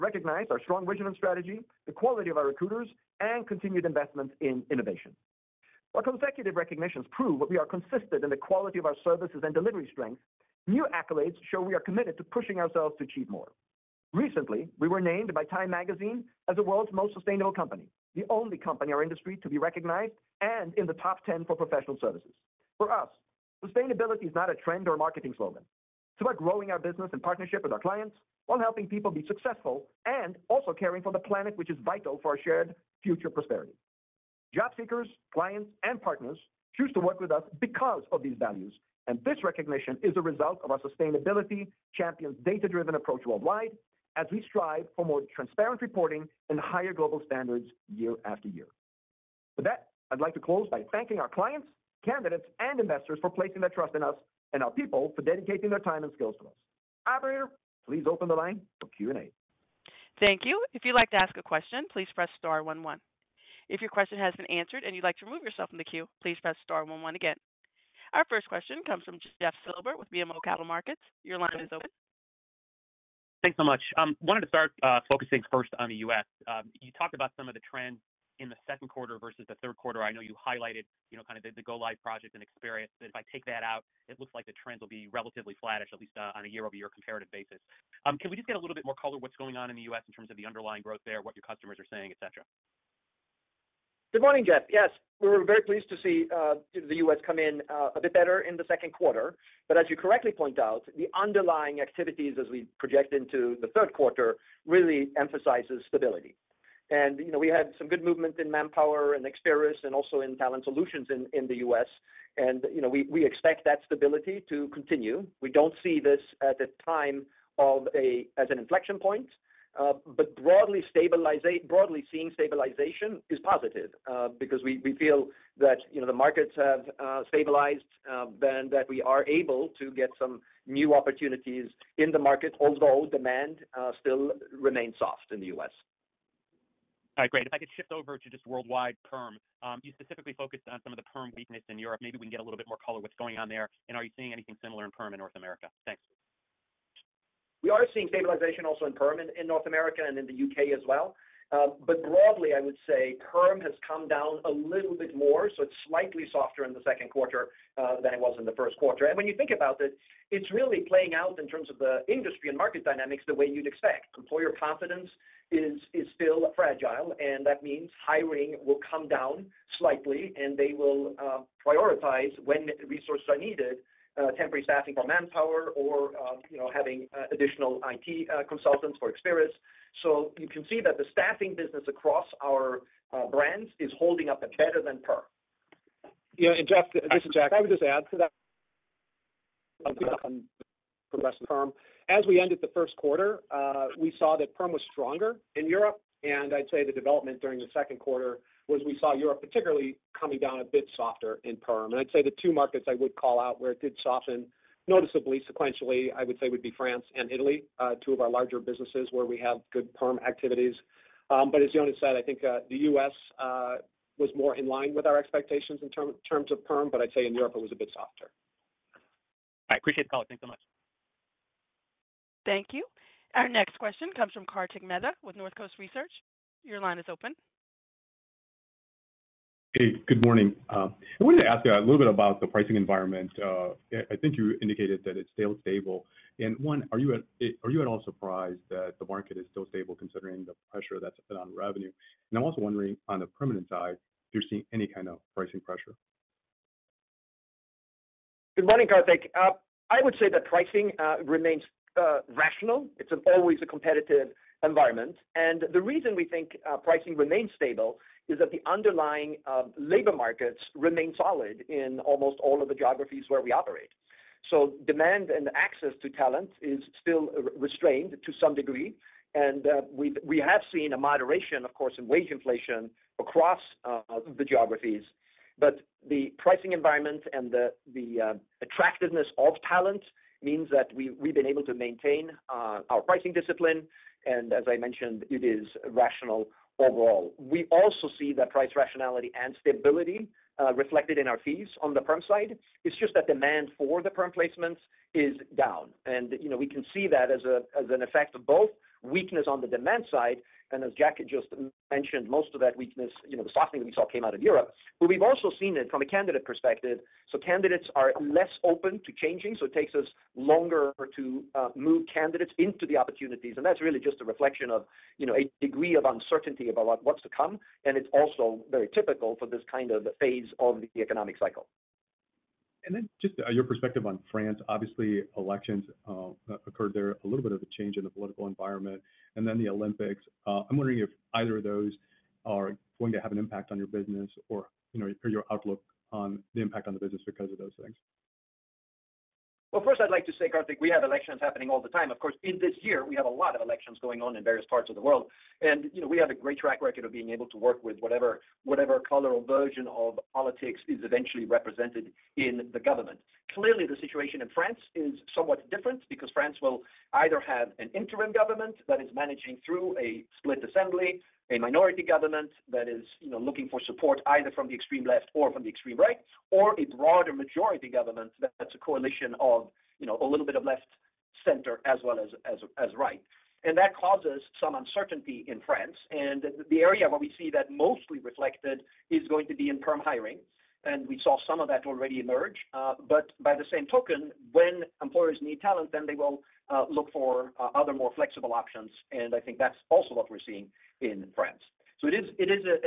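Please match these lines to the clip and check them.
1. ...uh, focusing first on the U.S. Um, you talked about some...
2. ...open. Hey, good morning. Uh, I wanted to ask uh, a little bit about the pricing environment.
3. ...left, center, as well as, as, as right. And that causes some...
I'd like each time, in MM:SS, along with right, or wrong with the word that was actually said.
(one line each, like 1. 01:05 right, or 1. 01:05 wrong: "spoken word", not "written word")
1. 01:14 right
2. 03:47 right
3. 06:10 right.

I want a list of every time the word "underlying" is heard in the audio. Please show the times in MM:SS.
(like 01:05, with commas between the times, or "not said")
01:30, 01:41, 04:18.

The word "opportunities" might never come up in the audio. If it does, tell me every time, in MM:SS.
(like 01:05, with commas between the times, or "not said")
02:10, 05:12.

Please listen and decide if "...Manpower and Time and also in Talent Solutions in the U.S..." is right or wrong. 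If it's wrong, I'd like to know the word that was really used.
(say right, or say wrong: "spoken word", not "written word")
wrong: "Experis", not "Time".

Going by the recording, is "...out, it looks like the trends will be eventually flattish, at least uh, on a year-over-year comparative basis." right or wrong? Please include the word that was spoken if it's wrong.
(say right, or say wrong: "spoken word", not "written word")
wrong: "relatively", not "eventually".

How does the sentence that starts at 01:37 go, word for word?
come in uh, a bit better in the second quarter.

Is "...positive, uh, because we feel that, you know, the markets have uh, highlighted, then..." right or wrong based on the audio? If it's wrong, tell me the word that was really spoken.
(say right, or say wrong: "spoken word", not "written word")
wrong: "stabilized", not "highlighted".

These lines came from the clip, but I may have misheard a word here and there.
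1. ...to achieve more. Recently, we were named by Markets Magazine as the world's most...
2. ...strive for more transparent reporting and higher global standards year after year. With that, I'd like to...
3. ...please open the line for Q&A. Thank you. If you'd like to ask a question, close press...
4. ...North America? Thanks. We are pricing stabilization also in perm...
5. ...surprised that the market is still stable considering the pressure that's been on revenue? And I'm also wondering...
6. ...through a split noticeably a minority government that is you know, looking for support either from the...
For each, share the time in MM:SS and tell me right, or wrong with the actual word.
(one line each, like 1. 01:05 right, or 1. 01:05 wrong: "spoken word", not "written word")
1. 00:12 wrong: "Time", not "Markets"
2. 00:44 right
3. 00:57 wrong: "please", not "close"
4. 02:25 wrong: "seeing", not "pricing"
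5. 03:58 right
6. 05:59 wrong: "assembly", not "noticeably".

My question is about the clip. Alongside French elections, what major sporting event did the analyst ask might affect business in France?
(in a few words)
the Olympics.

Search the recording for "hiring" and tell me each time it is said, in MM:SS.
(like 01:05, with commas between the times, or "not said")
02:48, 06:19.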